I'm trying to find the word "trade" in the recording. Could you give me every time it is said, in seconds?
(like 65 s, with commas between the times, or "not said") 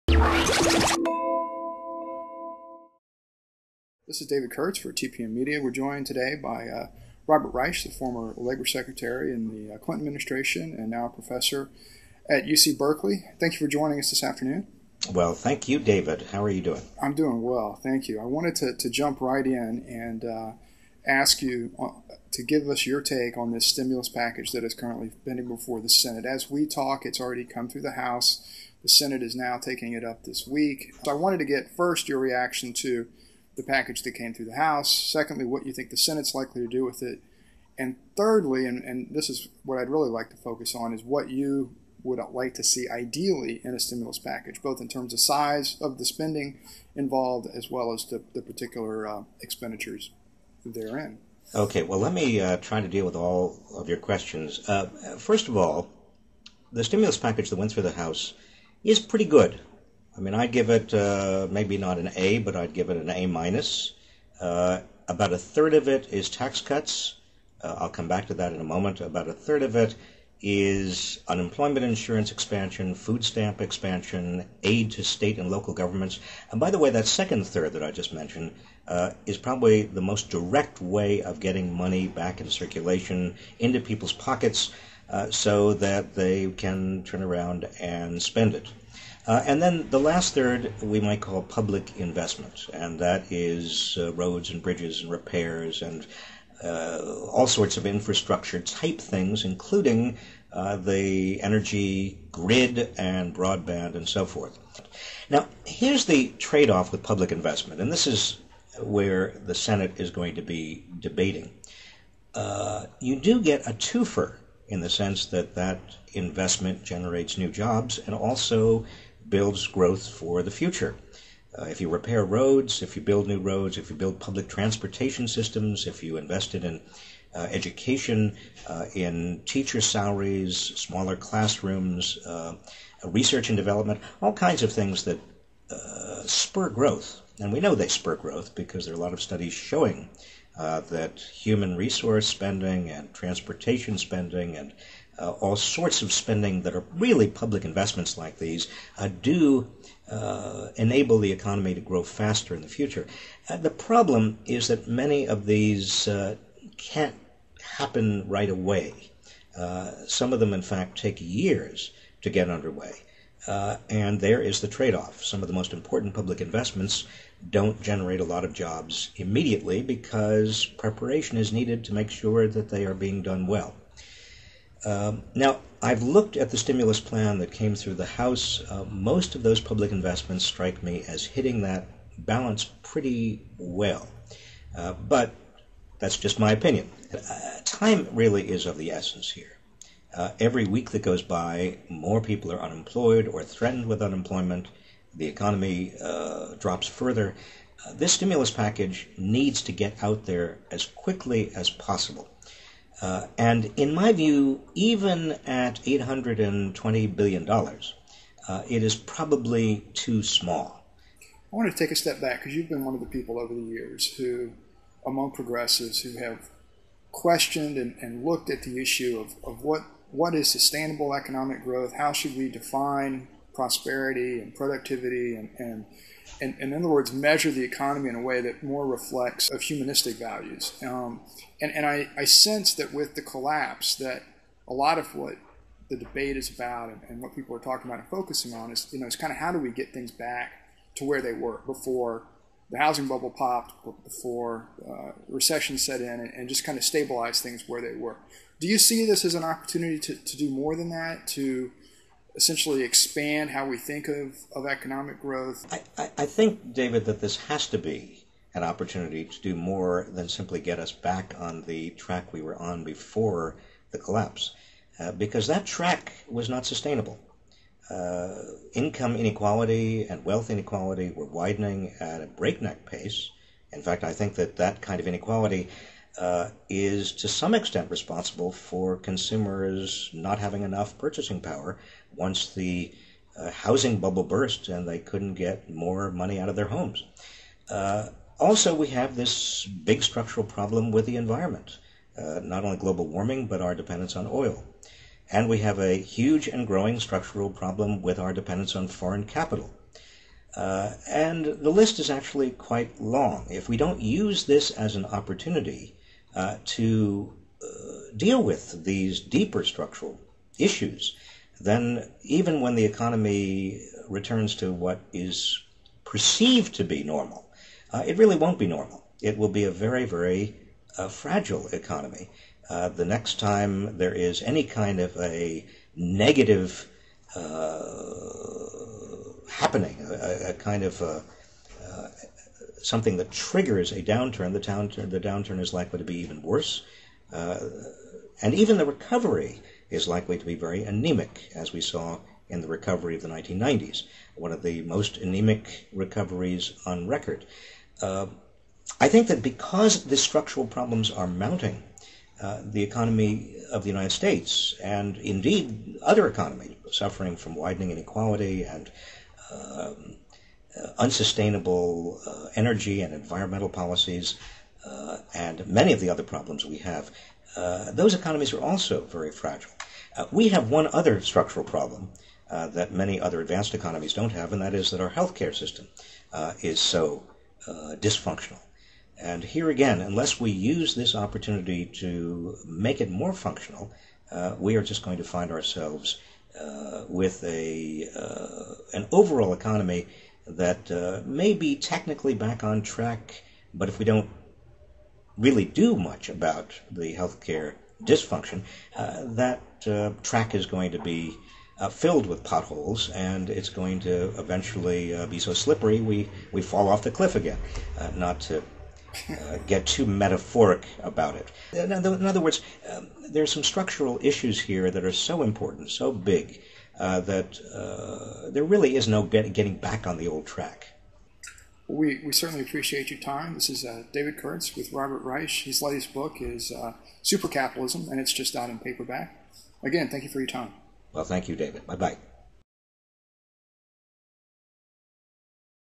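106 s, 164 s.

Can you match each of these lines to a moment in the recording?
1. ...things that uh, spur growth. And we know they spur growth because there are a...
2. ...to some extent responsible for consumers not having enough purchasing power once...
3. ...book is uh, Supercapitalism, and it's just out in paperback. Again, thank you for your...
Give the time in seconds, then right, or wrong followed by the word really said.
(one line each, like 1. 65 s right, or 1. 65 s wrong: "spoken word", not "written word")
1. 134 s right
2. 277 s right
3. 426 s right.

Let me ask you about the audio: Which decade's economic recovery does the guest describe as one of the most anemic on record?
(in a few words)
1990s.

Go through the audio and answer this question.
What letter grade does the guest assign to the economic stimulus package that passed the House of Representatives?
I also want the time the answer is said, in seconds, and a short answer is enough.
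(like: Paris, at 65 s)
A minus, at 63 s.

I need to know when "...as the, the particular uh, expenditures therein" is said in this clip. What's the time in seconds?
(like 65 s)
47 s.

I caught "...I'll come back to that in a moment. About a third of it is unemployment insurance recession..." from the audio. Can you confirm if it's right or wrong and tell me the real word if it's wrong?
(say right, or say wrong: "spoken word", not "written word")
wrong: "expansion", not "recession".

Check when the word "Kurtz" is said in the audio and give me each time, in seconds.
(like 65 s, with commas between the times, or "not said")
4 s, 424 s.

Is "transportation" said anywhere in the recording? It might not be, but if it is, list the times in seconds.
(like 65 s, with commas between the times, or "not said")
124 s, 143 s.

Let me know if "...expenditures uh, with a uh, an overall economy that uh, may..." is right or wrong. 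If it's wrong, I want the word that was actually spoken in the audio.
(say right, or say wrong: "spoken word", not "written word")
wrong: "ourselves", not "expenditures".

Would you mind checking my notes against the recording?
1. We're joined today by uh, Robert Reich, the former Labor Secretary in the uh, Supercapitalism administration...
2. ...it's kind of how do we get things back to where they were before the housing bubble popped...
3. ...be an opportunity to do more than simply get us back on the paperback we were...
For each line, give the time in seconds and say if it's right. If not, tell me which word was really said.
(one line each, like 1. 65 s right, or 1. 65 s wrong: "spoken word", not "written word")
1. 5 s wrong: "Clinton", not "Supercapitalism"
2. 239 s right
3. 257 s wrong: "track", not "paperback".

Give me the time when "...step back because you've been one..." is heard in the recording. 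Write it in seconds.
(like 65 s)
211 s.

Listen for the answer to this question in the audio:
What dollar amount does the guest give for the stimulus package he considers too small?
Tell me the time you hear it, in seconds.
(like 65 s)
205 s.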